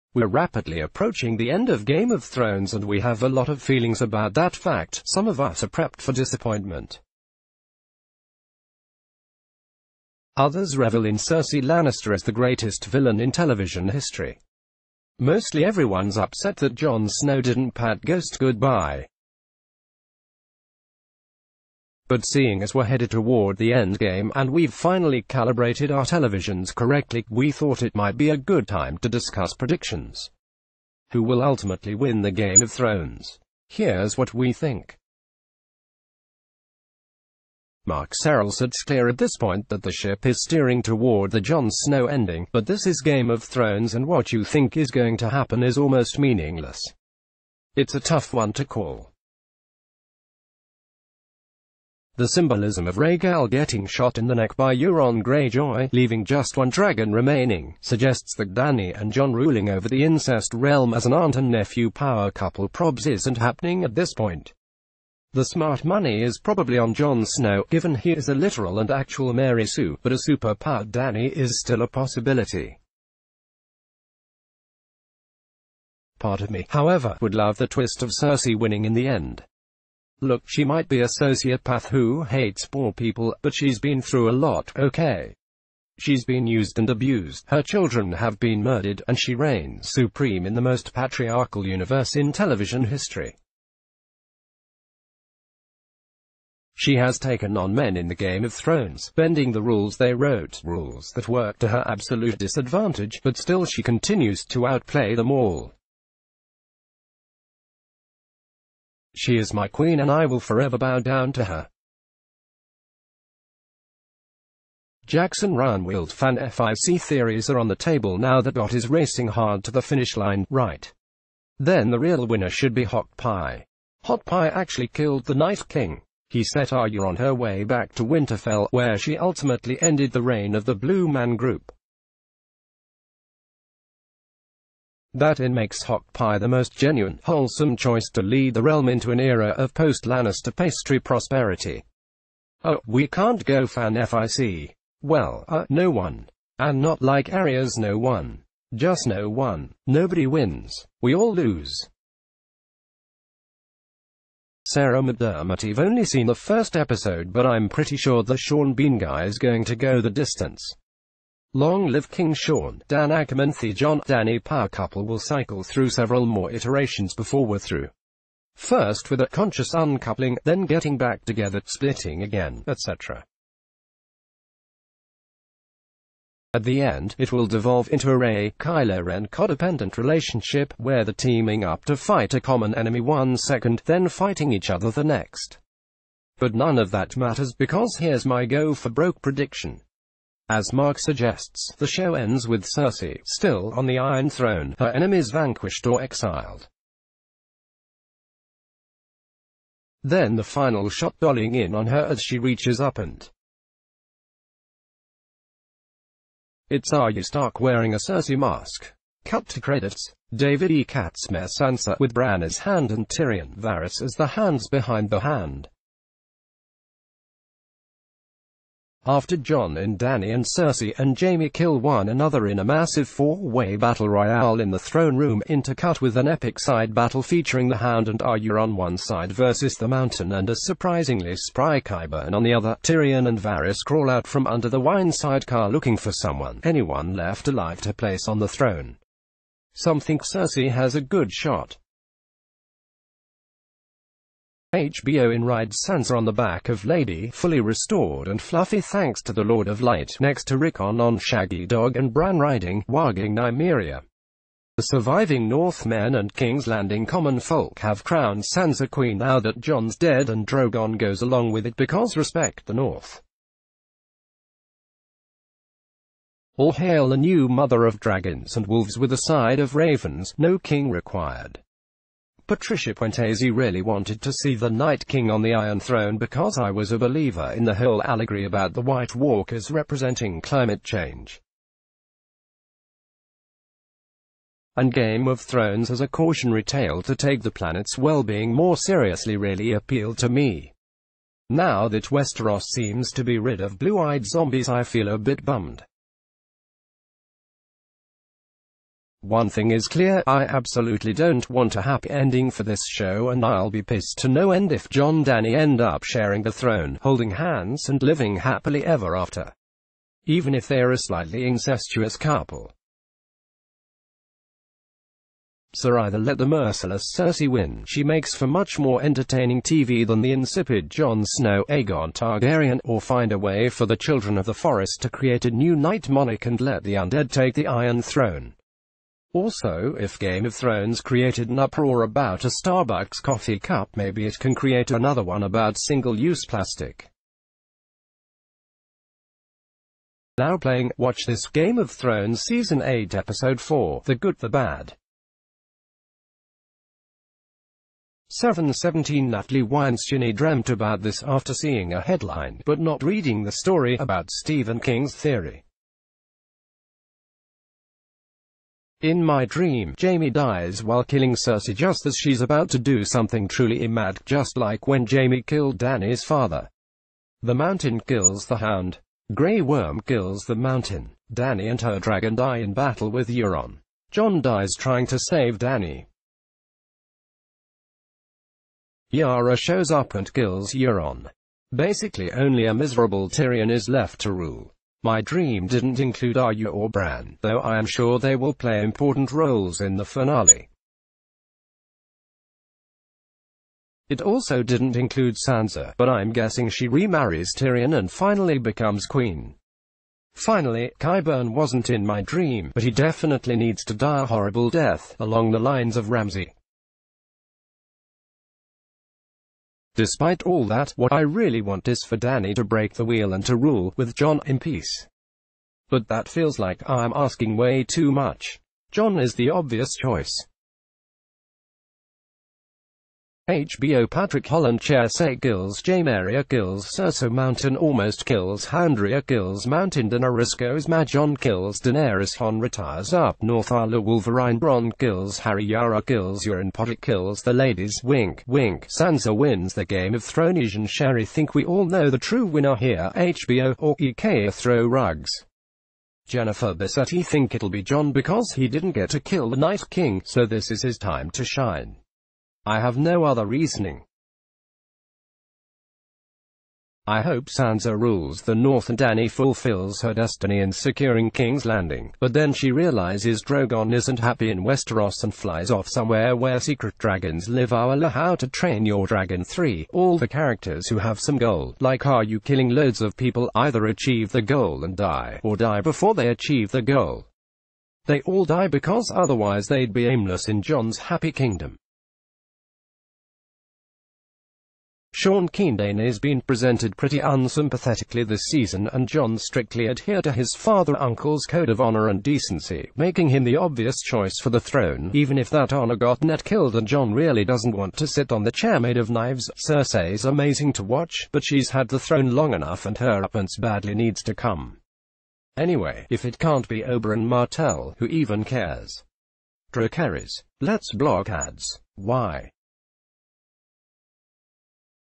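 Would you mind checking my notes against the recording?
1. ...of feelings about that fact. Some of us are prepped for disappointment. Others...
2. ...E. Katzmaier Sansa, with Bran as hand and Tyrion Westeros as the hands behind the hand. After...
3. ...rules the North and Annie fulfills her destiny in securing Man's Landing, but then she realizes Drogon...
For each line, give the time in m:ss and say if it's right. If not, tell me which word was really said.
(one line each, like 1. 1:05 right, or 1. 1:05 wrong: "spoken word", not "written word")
1. 0:03 right
2. 3:30 wrong: "Varys", not "Westeros"
3. 7:37 wrong: "King", not "Man".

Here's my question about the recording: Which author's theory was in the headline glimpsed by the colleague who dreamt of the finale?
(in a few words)
Stephen King.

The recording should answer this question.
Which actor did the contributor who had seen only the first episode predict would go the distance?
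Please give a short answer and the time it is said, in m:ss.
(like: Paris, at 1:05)
Sean Bean, at 2:38.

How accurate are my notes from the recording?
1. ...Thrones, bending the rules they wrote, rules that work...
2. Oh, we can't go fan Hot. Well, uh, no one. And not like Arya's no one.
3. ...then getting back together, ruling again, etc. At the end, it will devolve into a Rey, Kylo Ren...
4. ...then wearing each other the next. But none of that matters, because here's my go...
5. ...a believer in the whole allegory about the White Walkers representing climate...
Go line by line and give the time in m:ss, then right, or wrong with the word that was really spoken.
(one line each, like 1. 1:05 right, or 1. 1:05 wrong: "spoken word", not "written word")
1. 1:38 right
2. 2:22 wrong: "FIC", not "Hot"
3. 2:50 wrong: "splitting", not "ruling"
4. 3:03 wrong: "fighting", not "wearing"
5. 4:36 right.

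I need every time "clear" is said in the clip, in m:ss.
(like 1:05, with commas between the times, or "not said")
0:38, 4:59.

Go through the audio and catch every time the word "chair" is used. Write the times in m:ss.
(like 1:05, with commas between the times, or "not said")
7:04, 8:18.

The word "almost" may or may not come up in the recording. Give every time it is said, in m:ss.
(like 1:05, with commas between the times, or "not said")
0:45, 7:07.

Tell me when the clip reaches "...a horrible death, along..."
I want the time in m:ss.
6:44.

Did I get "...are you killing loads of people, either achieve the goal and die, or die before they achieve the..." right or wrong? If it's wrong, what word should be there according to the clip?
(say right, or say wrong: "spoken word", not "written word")
right.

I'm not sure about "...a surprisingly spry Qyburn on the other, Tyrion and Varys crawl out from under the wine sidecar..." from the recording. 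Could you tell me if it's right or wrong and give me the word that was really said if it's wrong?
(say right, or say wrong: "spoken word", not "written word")
right.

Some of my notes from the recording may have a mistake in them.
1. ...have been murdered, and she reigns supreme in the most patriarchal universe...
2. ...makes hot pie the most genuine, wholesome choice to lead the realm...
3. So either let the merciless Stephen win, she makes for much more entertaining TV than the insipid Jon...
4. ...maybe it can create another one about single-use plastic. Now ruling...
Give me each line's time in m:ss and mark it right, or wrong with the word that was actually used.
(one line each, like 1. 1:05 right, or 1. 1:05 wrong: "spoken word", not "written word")
1. 1:28 right
2. 2:15 right
3. 5:15 wrong: "Cersei", not "Stephen"
4. 5:33 wrong: "playing", not "ruling".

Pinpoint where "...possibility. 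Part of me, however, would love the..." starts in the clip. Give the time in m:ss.
1:11.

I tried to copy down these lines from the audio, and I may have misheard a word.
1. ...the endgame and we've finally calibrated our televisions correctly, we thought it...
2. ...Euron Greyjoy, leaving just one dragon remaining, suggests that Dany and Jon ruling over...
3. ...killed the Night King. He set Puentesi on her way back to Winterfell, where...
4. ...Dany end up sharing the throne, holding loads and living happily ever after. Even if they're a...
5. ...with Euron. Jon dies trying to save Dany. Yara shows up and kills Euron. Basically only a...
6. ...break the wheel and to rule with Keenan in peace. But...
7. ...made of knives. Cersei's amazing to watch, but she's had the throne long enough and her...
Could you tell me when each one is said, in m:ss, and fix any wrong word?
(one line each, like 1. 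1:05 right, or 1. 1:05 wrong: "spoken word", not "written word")
1. 0:23 right
2. 0:54 right
3. 2:04 wrong: "Arya", not "Puentesi"
4. 5:05 wrong: "hands", not "loads"
5. 6:13 right
6. 6:52 wrong: "Jon", not "Keenan"
7. 8:18 right.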